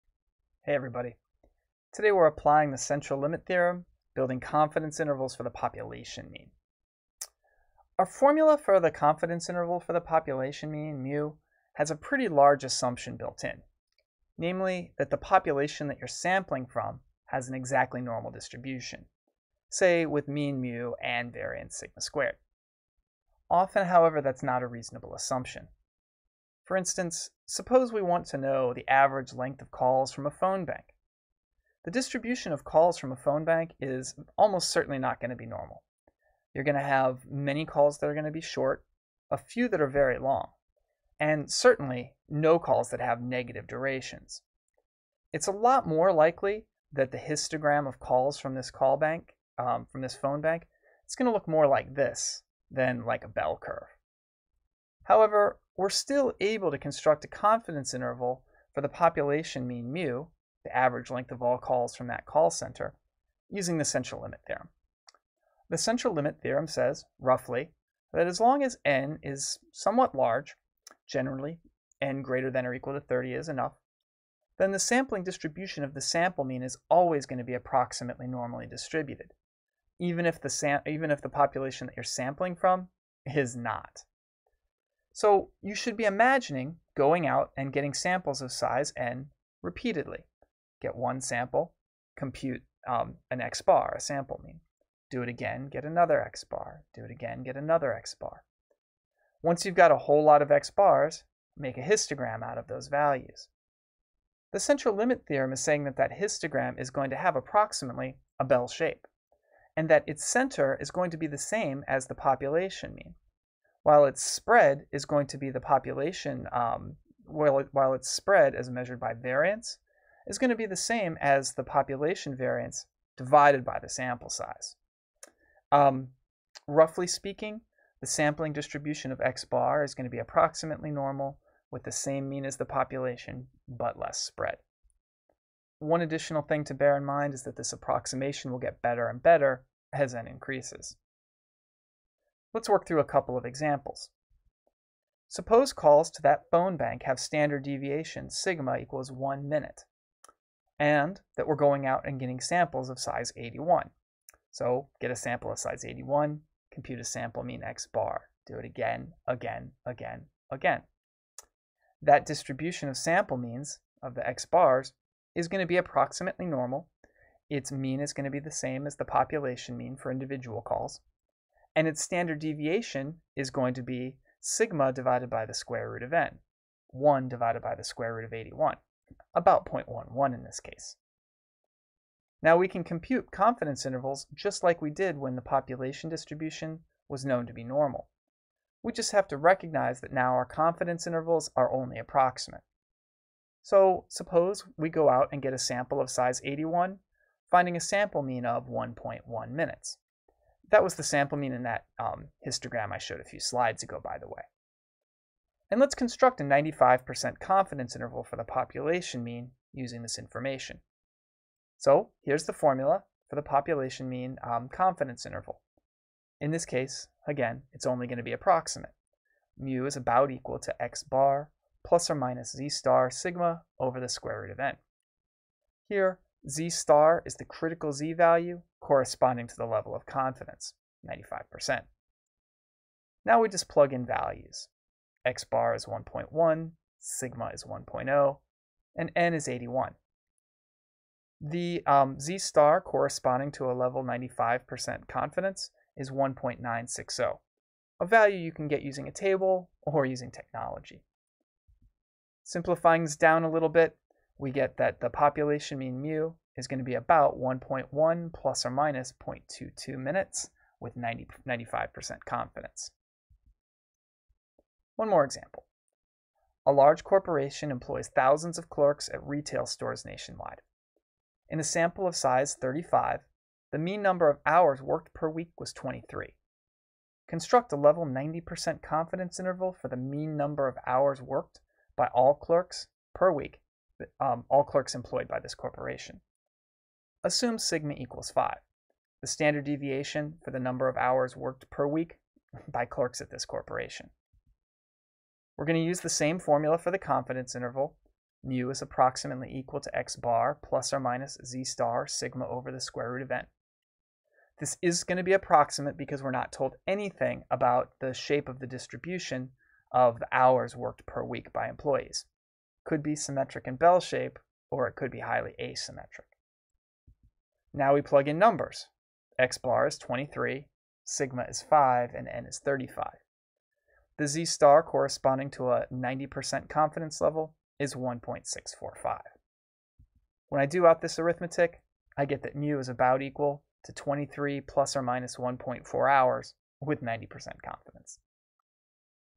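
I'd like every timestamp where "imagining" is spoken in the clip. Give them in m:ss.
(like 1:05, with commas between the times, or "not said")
1:26.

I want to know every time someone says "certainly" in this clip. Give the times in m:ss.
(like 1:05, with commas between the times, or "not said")
0:34, 0:41.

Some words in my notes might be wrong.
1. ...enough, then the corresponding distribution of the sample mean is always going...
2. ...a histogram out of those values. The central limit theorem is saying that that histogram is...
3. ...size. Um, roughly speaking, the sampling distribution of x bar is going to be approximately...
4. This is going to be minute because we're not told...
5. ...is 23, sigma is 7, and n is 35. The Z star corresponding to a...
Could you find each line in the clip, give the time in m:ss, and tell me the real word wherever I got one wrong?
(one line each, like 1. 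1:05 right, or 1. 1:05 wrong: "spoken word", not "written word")
1. 1:13 wrong: "sampling", not "corresponding"
2. 1:41 right
3. 2:04 right
4. 5:04 wrong: "approximate", not "minute"
5. 5:19 wrong: "5", not "7".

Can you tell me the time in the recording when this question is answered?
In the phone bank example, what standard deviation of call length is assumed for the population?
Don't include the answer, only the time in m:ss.
2:28.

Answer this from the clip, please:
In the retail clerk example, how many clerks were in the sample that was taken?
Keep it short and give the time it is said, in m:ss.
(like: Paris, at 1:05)
35, at 4:31.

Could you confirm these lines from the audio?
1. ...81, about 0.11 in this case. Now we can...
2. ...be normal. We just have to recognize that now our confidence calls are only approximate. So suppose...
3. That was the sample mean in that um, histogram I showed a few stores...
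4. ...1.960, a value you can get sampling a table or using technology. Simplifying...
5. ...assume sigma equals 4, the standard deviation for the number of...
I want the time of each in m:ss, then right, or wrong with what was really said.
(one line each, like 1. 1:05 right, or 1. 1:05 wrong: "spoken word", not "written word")
1. 2:58 right
2. 3:07 wrong: "intervals", not "calls"
3. 3:20 wrong: "slides", not "stores"
4. 4:06 wrong: "using", not "sampling"
5. 4:47 wrong: "5", not "4".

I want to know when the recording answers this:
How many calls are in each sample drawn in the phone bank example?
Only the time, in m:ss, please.
2:32.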